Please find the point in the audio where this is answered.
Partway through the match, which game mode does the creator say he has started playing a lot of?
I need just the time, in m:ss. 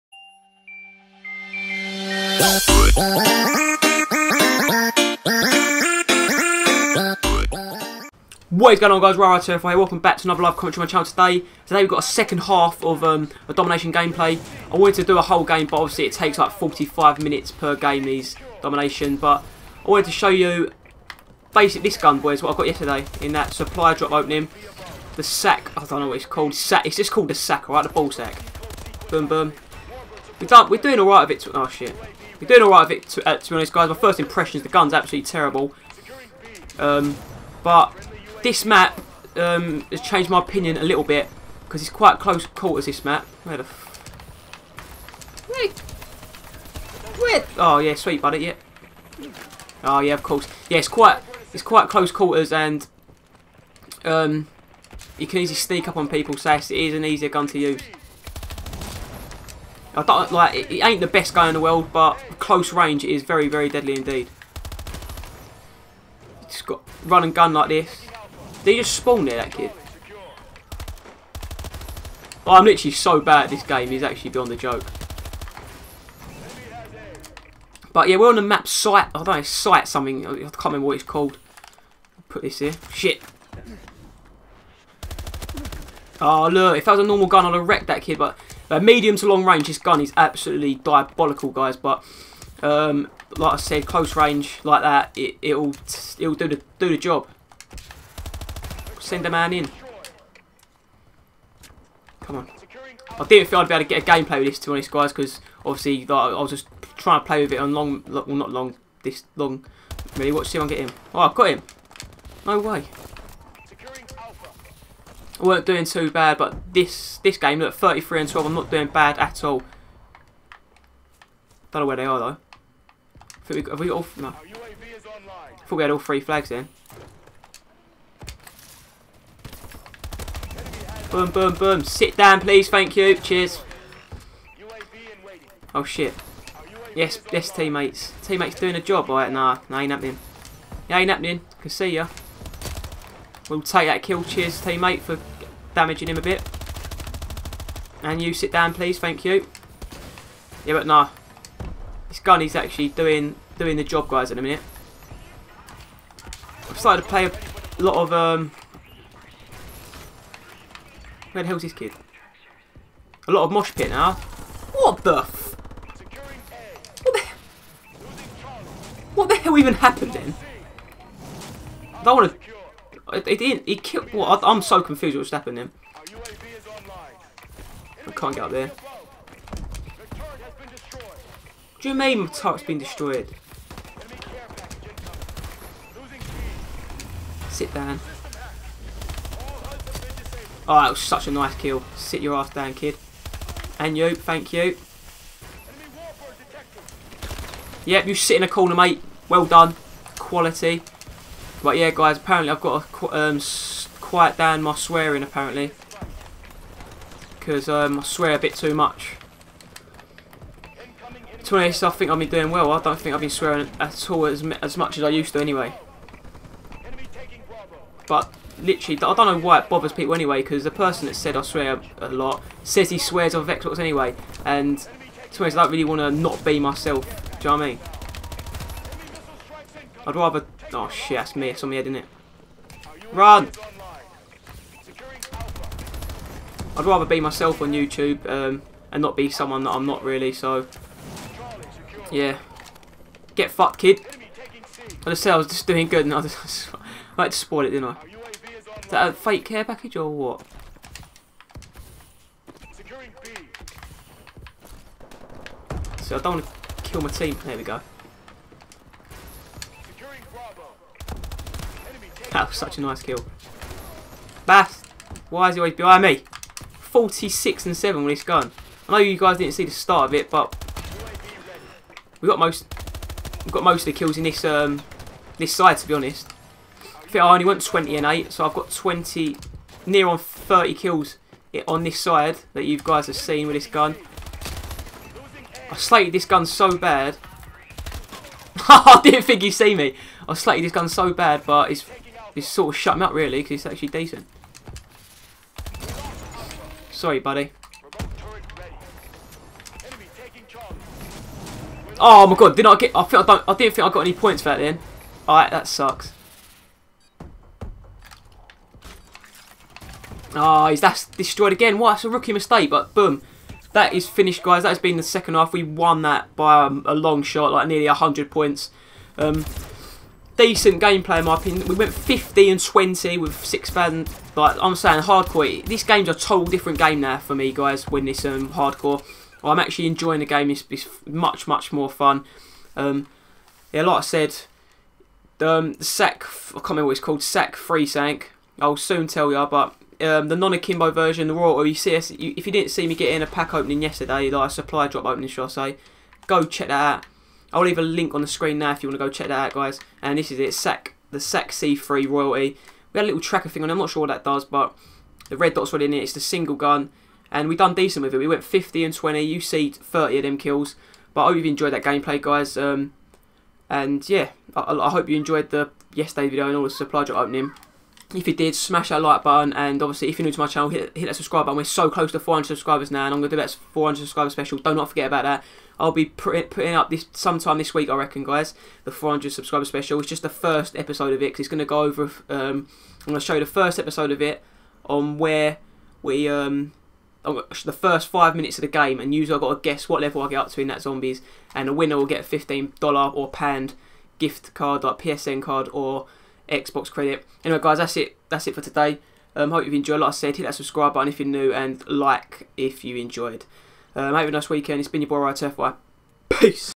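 2:43.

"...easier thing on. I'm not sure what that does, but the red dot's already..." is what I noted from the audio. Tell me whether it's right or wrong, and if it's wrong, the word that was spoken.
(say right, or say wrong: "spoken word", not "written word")
wrong: "tracker", not "easier".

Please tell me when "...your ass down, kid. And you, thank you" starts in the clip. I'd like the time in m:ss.
3:12.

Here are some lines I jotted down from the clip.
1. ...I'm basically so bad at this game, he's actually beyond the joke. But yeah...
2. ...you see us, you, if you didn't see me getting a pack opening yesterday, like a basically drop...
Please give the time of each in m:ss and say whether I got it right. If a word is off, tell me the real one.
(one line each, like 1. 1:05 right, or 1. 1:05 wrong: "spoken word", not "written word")
1. 1:12 wrong: "literally", not "basically"
2. 5:41 wrong: "supply", not "basically".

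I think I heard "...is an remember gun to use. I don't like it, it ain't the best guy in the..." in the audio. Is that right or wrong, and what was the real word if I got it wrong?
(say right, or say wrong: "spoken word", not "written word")
wrong: "easier", not "remember".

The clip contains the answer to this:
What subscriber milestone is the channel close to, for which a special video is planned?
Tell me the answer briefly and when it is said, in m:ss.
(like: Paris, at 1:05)
400, at 6:12.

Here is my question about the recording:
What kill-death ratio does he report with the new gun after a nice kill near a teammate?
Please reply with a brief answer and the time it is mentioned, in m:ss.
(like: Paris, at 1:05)
46 and 7, at 4:26.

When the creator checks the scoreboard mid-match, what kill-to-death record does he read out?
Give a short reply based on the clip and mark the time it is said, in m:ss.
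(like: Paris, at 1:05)
33 and 12, at 1:57.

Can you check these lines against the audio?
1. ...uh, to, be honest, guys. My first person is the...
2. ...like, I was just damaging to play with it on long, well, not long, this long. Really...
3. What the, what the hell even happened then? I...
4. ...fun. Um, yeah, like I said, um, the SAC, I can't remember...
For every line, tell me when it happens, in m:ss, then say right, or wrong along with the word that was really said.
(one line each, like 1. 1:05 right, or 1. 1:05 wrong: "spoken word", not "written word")
1. 0:33 wrong: "impression", not "person"
2. 1:46 wrong: "trying", not "damaging"
3. 2:47 right
4. 5:31 right.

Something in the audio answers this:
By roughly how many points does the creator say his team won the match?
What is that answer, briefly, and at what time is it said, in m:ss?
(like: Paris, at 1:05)
100, at 5:17.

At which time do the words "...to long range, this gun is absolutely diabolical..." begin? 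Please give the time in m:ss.
1:29.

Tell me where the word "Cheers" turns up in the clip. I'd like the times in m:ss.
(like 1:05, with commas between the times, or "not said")
2:13, 2:24.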